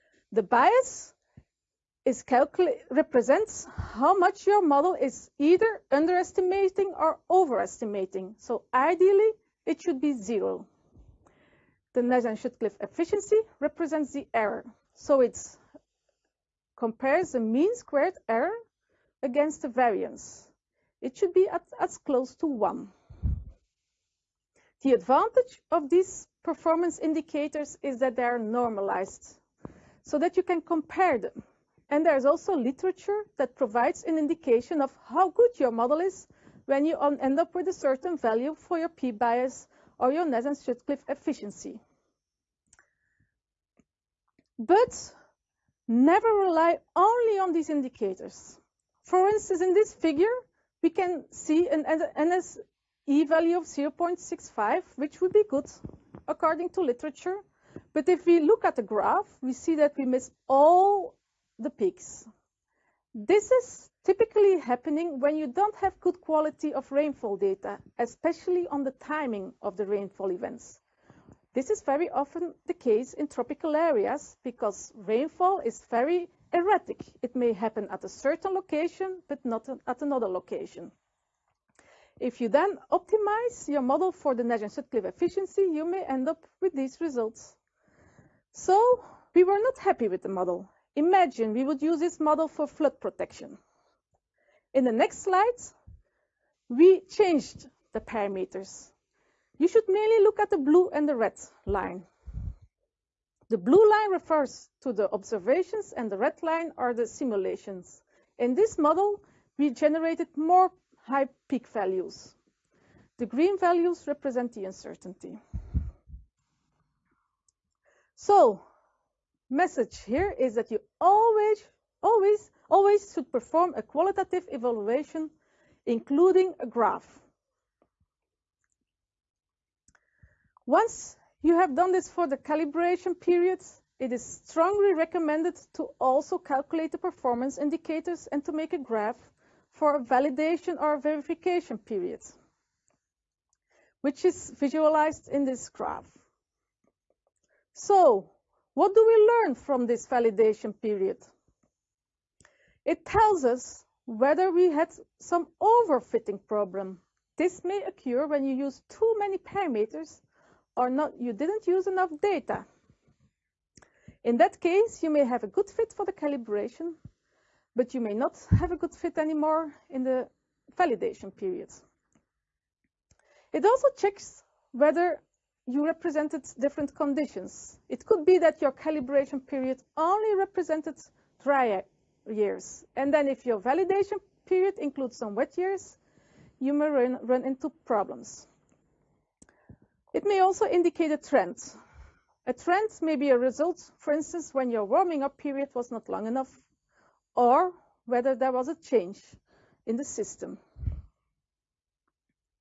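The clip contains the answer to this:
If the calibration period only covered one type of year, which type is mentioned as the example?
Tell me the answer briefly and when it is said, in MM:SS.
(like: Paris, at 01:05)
dry years, at 03:01.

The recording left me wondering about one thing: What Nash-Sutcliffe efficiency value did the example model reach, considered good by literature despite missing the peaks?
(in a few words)
0.65.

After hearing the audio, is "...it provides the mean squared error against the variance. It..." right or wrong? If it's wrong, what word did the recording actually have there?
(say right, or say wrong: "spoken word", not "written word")
wrong: "compares", not "provides".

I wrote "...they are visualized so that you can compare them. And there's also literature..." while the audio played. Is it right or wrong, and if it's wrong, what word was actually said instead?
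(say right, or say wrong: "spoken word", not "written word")
wrong: "normalized", not "visualized".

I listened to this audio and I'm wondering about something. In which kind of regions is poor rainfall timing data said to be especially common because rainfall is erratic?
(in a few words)
tropical areas.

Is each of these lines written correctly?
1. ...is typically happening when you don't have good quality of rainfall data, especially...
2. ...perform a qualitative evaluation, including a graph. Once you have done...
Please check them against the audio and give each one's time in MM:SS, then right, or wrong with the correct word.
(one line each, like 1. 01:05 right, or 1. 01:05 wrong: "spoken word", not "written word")
1. 01:03 right
2. 02:03 right.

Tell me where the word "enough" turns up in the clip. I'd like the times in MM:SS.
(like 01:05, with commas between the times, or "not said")
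02:41, 03:16.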